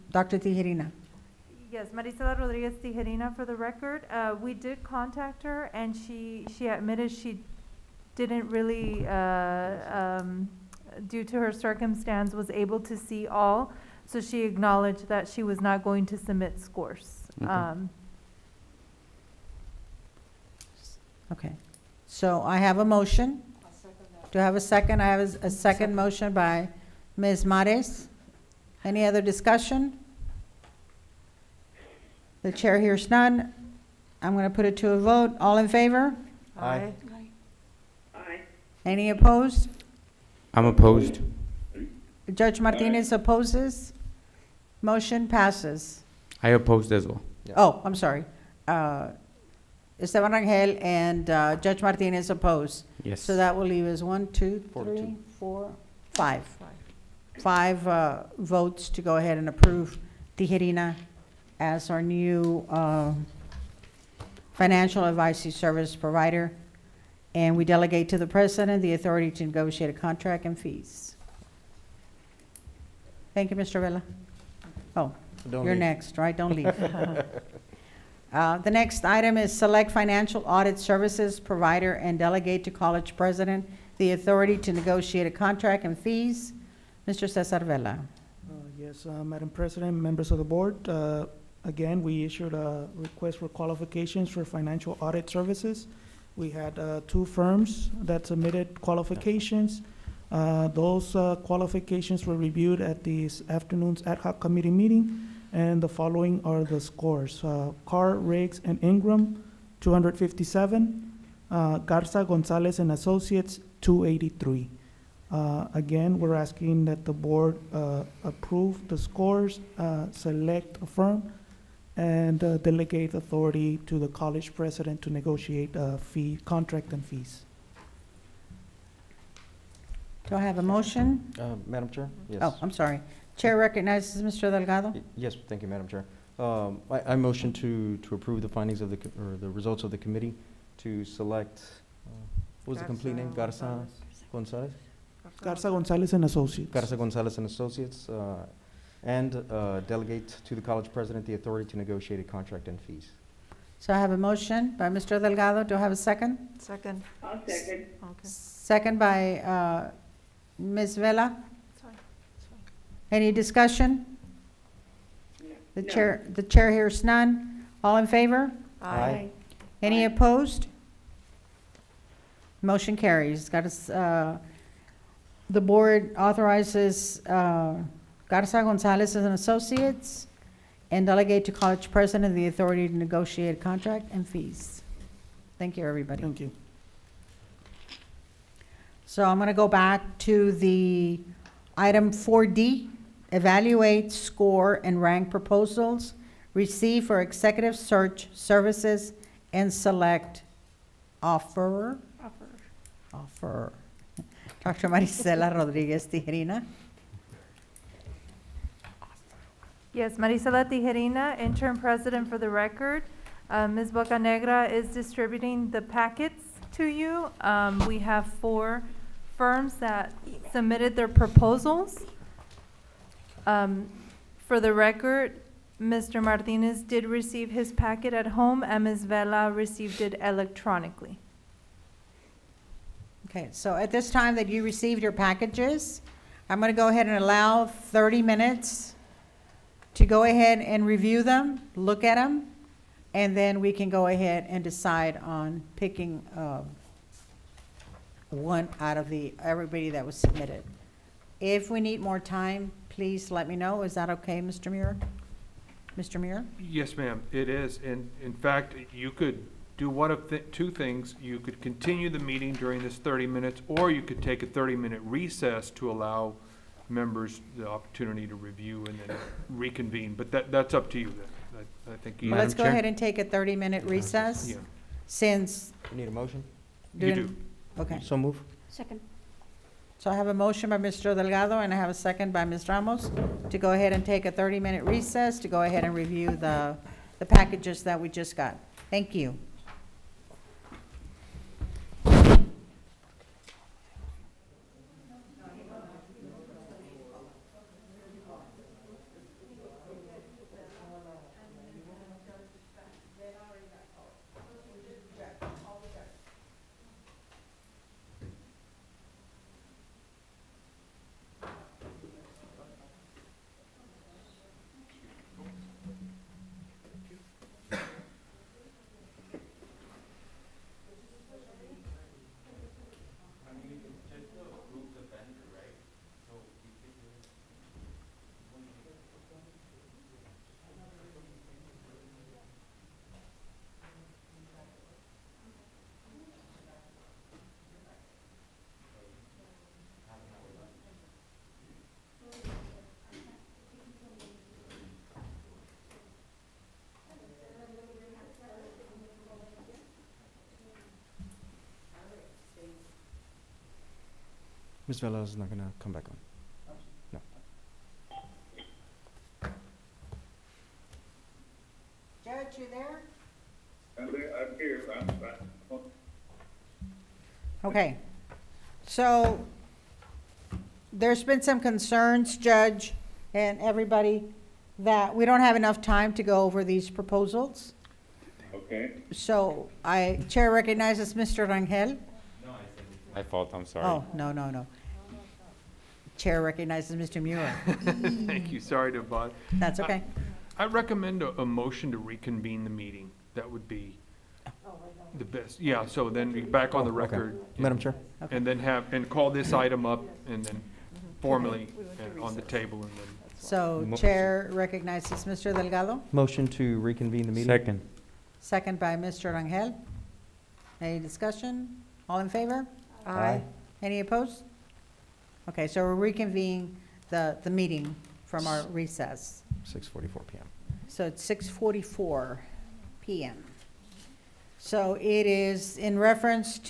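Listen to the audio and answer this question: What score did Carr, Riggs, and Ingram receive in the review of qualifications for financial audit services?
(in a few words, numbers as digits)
257.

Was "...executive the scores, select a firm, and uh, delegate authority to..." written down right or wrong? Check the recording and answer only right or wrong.
wrong.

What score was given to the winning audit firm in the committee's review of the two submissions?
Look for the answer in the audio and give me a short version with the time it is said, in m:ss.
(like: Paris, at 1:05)
283, at 1:53.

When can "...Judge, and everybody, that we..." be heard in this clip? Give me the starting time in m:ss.
6:12.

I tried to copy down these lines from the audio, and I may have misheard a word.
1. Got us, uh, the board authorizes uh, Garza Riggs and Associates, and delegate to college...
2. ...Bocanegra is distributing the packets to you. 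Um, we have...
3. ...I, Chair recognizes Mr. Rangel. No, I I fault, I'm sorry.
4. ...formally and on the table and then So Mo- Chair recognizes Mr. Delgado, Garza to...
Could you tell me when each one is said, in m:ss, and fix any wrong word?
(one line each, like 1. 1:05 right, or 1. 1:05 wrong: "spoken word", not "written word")
1. 2:53 wrong: "Gonzalez", not "Riggs"
2. 3:33 right
3. 6:19 right
4. 6:41 wrong: "Motion", not "Garza".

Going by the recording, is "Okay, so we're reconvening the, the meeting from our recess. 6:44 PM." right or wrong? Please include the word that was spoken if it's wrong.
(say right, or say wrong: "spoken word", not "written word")
right.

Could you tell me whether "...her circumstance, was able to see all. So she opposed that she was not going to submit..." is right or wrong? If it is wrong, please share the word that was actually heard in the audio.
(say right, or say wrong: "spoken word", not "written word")
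wrong: "acknowledged", not "opposed".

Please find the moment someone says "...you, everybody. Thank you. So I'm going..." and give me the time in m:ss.
3:05.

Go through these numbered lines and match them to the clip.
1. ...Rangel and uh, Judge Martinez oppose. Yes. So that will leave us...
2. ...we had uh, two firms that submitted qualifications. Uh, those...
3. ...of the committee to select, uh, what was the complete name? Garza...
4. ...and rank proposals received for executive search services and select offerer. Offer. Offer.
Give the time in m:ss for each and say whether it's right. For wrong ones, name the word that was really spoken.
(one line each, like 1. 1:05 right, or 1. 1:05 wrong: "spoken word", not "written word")
1. 0:50 right
2. 1:36 right
3. 2:19 right
4. 3:14 right.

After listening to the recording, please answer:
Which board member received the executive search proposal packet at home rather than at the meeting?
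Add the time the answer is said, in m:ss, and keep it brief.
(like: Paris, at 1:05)
Mr. Martinez, at 3:45.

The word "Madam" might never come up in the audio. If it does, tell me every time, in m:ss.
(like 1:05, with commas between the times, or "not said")
1:29, 2:11, 2:15, 6:37.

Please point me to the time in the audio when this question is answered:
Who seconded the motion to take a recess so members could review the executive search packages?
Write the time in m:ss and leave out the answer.
4:42.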